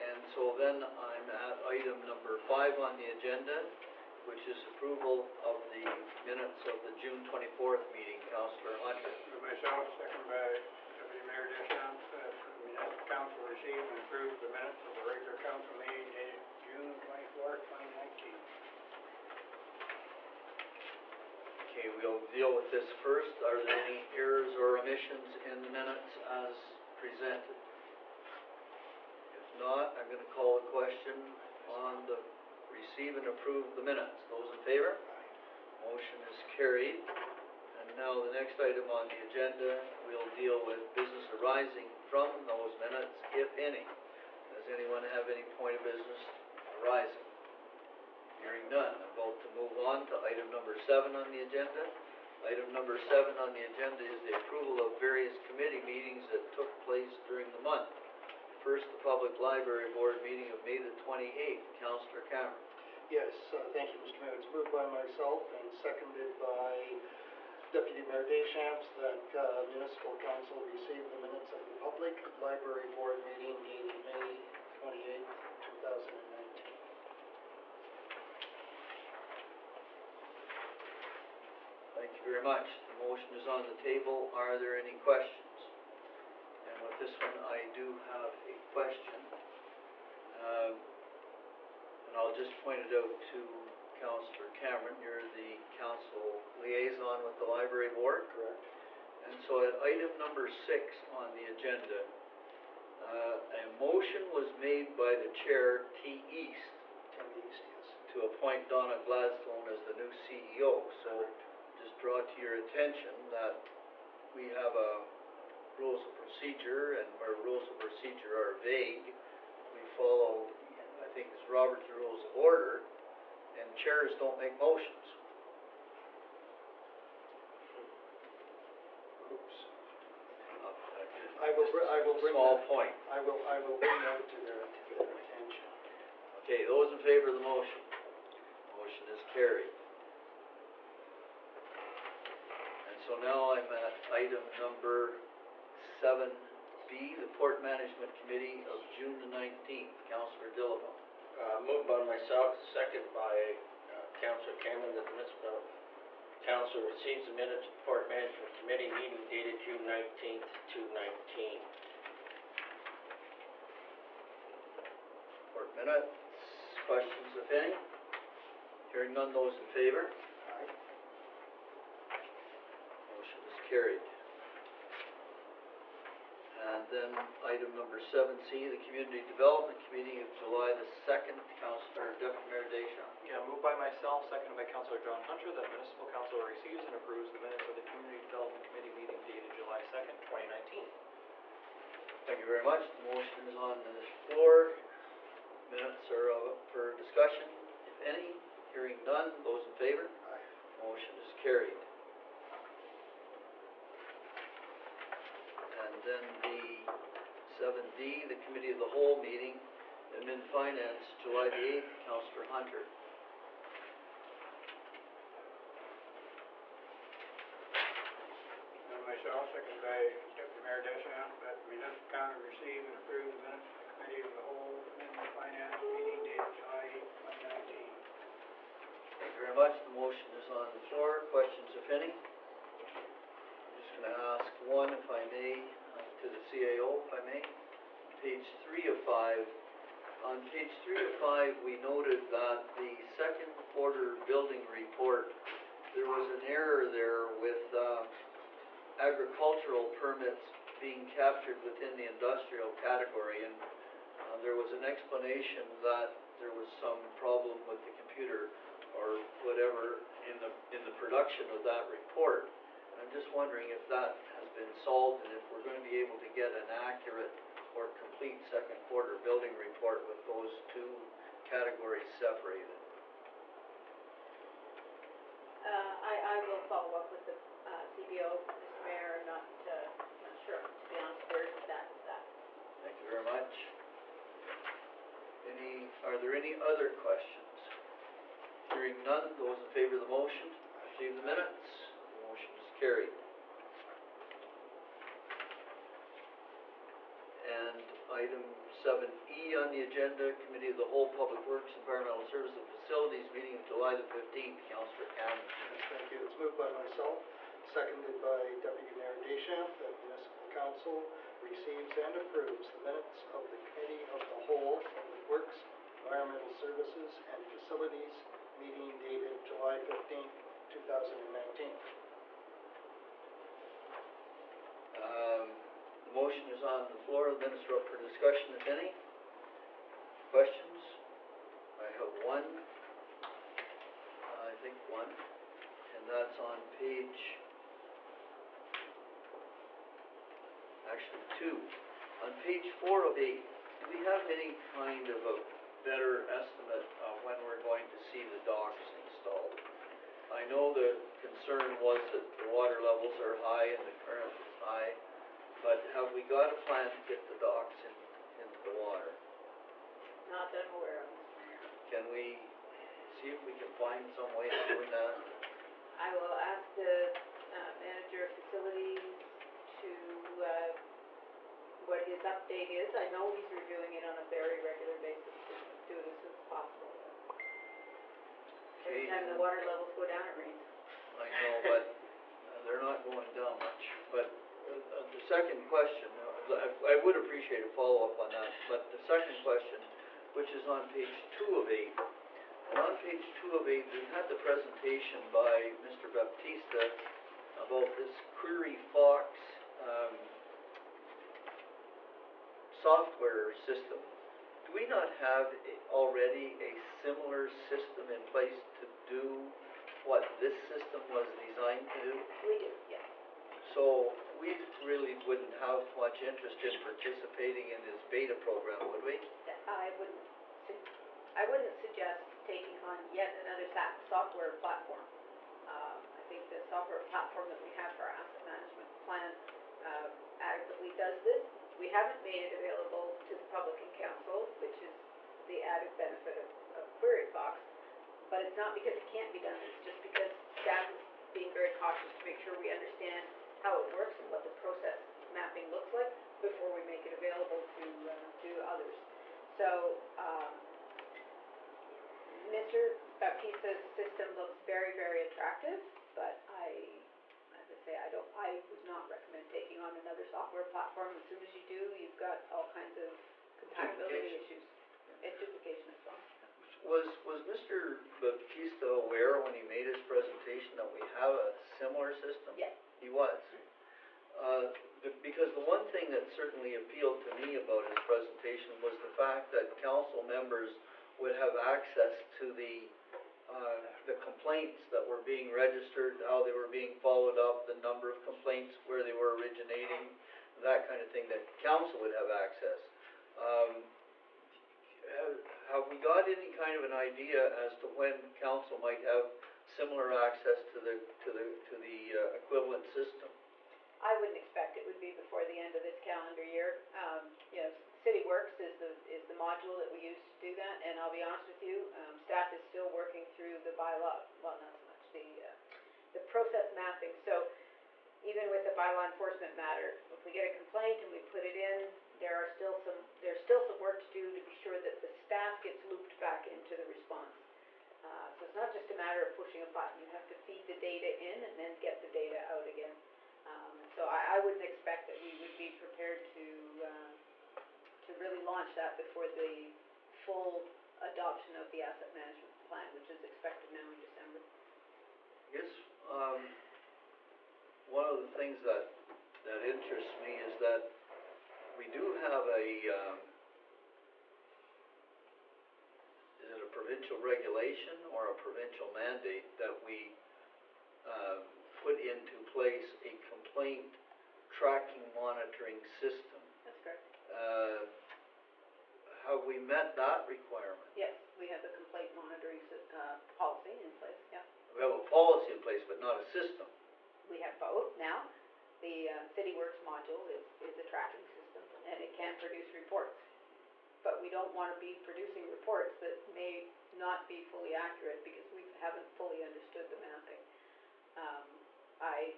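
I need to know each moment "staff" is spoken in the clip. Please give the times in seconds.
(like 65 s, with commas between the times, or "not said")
440 s, 512 s, 525 s.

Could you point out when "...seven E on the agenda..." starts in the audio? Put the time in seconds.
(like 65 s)
298 s.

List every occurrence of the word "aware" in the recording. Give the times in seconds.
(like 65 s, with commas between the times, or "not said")
360 s, 468 s.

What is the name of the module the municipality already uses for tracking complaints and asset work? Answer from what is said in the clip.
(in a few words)
Cityworks.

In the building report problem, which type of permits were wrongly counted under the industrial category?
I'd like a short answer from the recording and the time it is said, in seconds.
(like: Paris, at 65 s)
Agricultural, at 248 s.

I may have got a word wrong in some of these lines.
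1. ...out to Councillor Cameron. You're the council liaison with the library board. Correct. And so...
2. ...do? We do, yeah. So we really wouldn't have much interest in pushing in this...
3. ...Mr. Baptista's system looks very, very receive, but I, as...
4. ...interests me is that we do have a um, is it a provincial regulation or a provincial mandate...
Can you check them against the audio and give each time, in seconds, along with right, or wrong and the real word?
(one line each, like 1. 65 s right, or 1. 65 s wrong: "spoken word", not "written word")
1. 92 s right
2. 412 s wrong: "participating", not "pushing"
3. 452 s wrong: "attractive", not "receive"
4. 549 s right.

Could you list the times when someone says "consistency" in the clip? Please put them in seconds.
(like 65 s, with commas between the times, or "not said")
not said.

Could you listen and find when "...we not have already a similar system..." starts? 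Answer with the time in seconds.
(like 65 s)
404 s.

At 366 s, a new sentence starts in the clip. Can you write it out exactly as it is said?
I will ask the uh, manager of facilities to, uh, what his update is.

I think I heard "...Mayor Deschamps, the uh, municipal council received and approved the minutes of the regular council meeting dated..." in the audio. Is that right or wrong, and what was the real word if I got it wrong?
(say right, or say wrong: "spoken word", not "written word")
right.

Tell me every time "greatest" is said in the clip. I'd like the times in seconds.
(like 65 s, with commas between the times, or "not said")
not said.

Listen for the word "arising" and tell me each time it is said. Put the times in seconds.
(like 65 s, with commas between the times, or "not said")
41 s, 46 s.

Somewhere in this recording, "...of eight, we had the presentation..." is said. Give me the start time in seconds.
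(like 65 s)
393 s.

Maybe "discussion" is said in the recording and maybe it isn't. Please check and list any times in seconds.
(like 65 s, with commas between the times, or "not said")
196 s, 327 s.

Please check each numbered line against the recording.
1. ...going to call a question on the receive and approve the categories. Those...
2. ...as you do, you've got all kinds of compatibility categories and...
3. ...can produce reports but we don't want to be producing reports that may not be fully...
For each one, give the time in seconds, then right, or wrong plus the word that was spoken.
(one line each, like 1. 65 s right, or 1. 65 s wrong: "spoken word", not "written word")
1. 30 s wrong: "minutes", not "categories"
2. 461 s wrong: "issues", not "categories"
3. 582 s right.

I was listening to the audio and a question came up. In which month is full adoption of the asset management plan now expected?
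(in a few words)
December.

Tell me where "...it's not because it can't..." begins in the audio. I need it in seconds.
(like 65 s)
438 s.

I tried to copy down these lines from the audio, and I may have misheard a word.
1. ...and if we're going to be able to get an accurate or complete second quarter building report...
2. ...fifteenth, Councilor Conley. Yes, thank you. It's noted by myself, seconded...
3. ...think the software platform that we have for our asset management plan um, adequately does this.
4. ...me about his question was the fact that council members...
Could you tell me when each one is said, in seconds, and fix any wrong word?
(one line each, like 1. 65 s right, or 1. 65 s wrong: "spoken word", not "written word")
1. 265 s right
2. 304 s wrong: "moved", not "noted"
3. 426 s right
4. 477 s wrong: "presentation", not "question".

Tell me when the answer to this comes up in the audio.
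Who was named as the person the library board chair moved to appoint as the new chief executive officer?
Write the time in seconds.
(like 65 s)
108 s.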